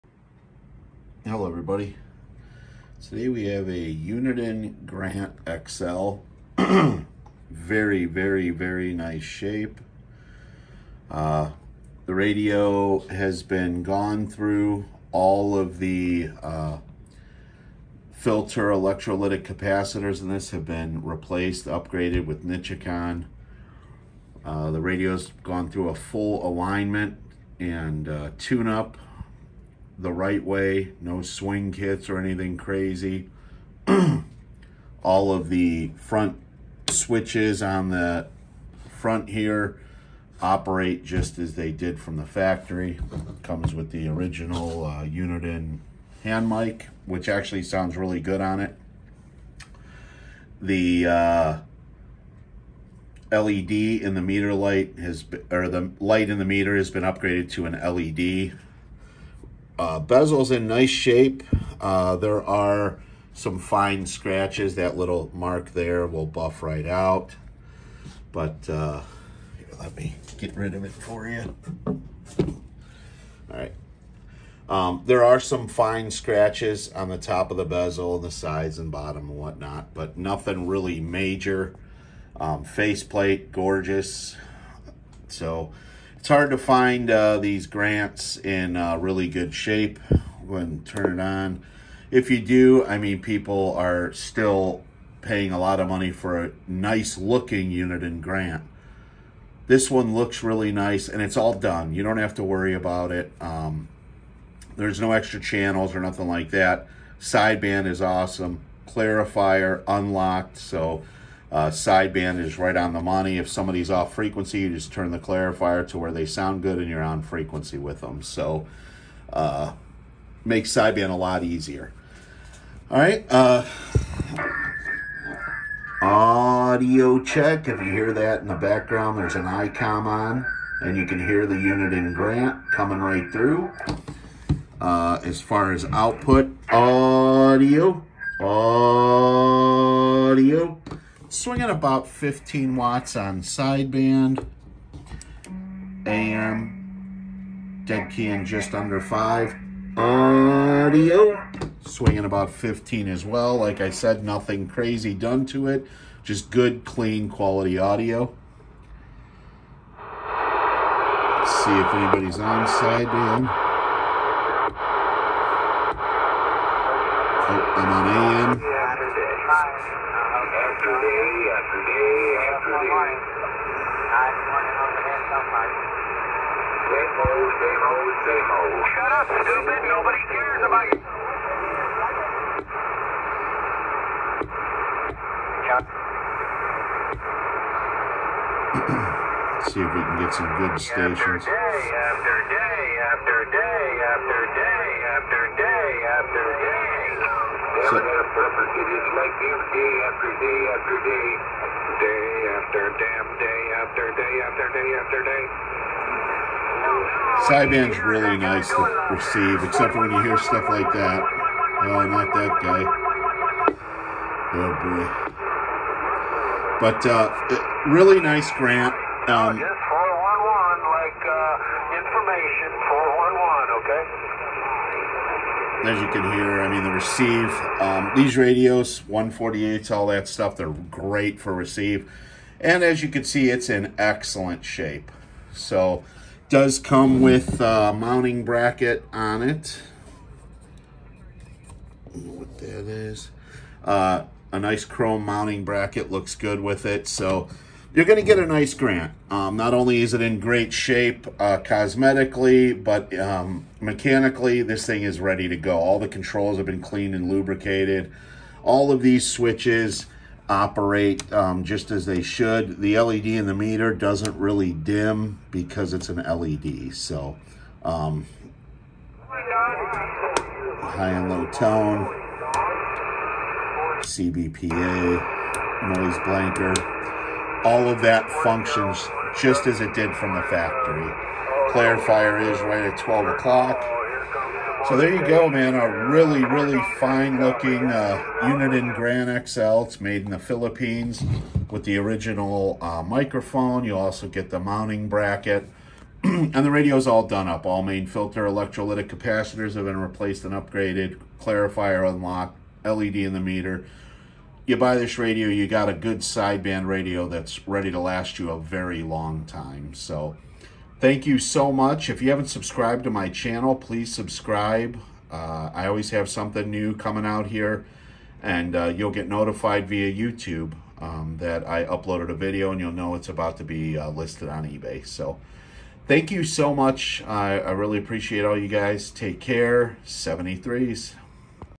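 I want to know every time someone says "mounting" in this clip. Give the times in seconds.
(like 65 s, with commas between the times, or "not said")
237 s, 245 s, 294 s.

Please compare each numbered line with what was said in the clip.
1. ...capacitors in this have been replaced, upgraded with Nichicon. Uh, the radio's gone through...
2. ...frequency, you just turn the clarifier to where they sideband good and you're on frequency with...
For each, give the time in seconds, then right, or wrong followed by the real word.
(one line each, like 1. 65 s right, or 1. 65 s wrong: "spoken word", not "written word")
1. 19 s right
2. 114 s wrong: "sound", not "sideband".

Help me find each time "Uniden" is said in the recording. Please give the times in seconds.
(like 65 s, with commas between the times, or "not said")
3 s, 45 s, 97 s, 131 s.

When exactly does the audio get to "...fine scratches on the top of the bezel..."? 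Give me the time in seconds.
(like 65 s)
75 s.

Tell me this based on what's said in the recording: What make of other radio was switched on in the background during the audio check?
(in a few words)
ICOM.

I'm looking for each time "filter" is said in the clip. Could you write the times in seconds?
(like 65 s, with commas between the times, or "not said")
18 s, 298 s.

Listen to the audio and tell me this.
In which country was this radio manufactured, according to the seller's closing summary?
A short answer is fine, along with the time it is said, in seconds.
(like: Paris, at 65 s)
Philippines, at 290 s.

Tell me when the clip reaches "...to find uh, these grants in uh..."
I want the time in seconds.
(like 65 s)
86 s.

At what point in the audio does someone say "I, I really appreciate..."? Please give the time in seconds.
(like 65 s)
327 s.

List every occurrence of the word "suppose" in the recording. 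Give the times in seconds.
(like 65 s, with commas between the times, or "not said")
not said.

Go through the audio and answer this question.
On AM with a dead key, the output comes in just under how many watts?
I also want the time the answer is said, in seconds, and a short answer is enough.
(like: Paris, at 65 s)
5, at 148 s.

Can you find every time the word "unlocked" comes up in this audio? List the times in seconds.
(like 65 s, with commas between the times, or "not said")
109 s, 302 s.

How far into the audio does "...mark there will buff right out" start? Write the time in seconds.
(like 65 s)
65 s.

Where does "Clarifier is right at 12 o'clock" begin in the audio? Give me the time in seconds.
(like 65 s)
281 s.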